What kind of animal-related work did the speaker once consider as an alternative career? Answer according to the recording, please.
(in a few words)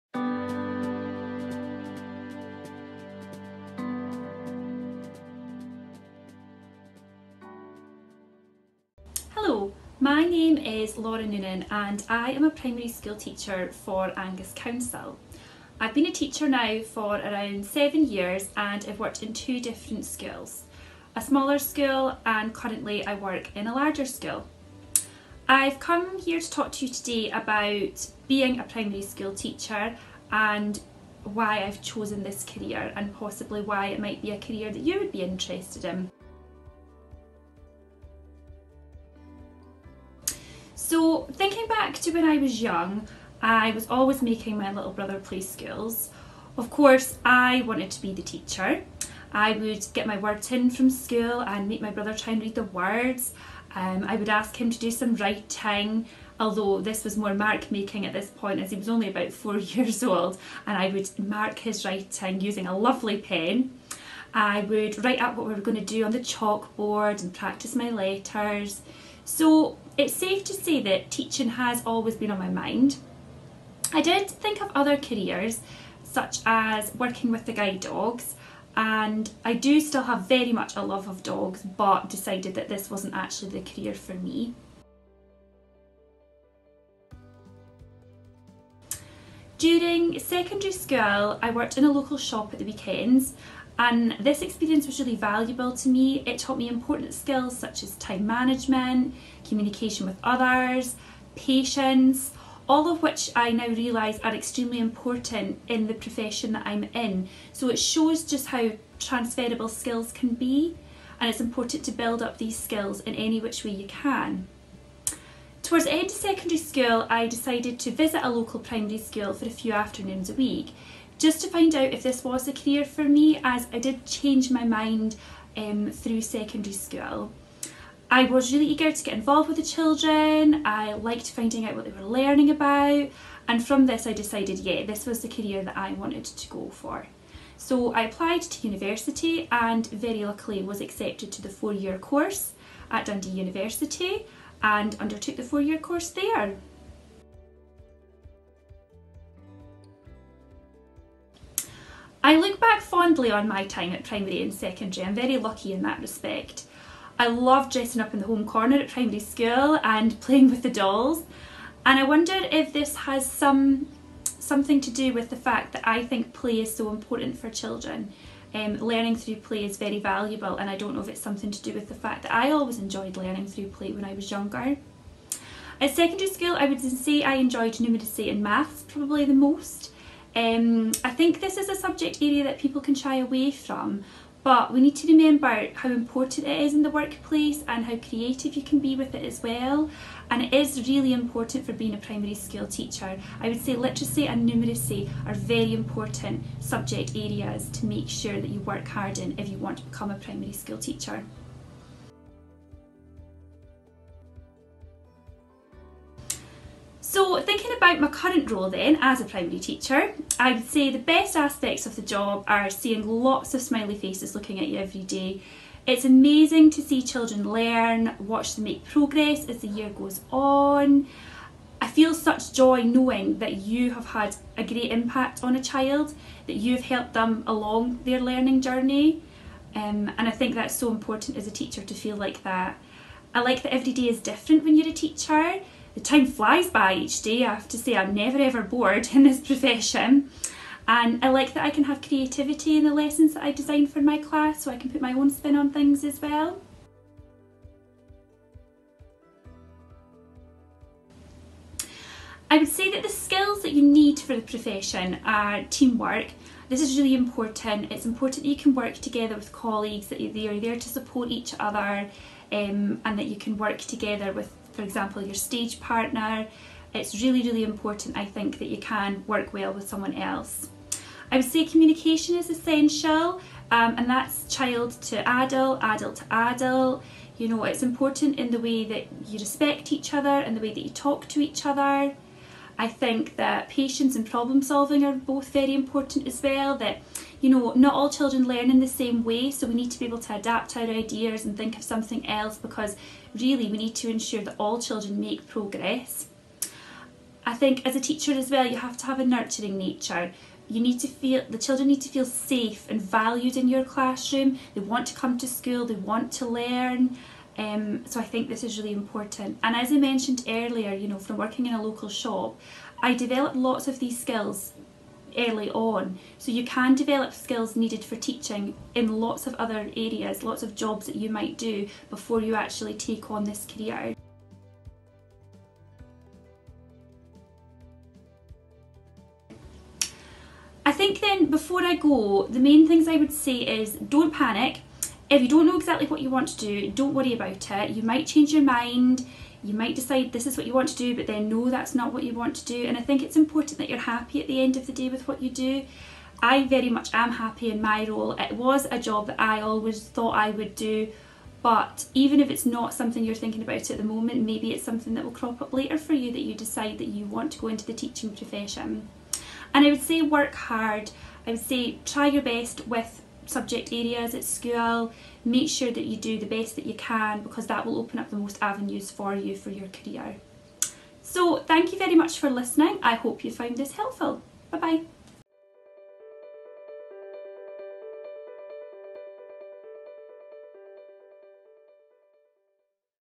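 Guide dogs.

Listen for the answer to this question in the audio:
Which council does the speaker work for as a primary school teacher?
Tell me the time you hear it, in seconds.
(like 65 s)
14 s.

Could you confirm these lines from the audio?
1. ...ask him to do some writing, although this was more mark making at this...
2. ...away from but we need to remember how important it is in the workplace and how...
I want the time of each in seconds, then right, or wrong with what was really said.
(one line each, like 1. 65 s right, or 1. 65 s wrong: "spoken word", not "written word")
1. 54 s right
2. 183 s right.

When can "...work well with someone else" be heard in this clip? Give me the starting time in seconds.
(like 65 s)
269 s.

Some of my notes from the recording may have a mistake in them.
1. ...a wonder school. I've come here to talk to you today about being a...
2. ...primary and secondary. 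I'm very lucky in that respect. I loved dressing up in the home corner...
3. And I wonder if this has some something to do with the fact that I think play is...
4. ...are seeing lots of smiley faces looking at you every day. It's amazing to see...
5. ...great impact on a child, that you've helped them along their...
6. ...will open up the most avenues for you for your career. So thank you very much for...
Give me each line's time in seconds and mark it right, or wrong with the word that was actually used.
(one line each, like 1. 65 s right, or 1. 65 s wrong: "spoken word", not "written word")
1. 23 s wrong: "larger", not "wonder"
2. 154 s right
3. 161 s right
4. 212 s right
5. 224 s right
6. 367 s right.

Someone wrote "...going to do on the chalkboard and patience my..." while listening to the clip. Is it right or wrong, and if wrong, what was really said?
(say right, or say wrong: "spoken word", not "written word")
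wrong: "practice", not "patience".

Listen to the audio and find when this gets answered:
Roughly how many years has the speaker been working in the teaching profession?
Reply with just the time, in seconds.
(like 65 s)
17 s.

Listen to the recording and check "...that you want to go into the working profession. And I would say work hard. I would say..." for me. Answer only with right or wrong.
wrong.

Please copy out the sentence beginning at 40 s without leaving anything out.
So thinking back to when I was young, I was always making my little brother play skills.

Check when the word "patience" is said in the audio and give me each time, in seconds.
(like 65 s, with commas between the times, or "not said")
101 s, 283 s.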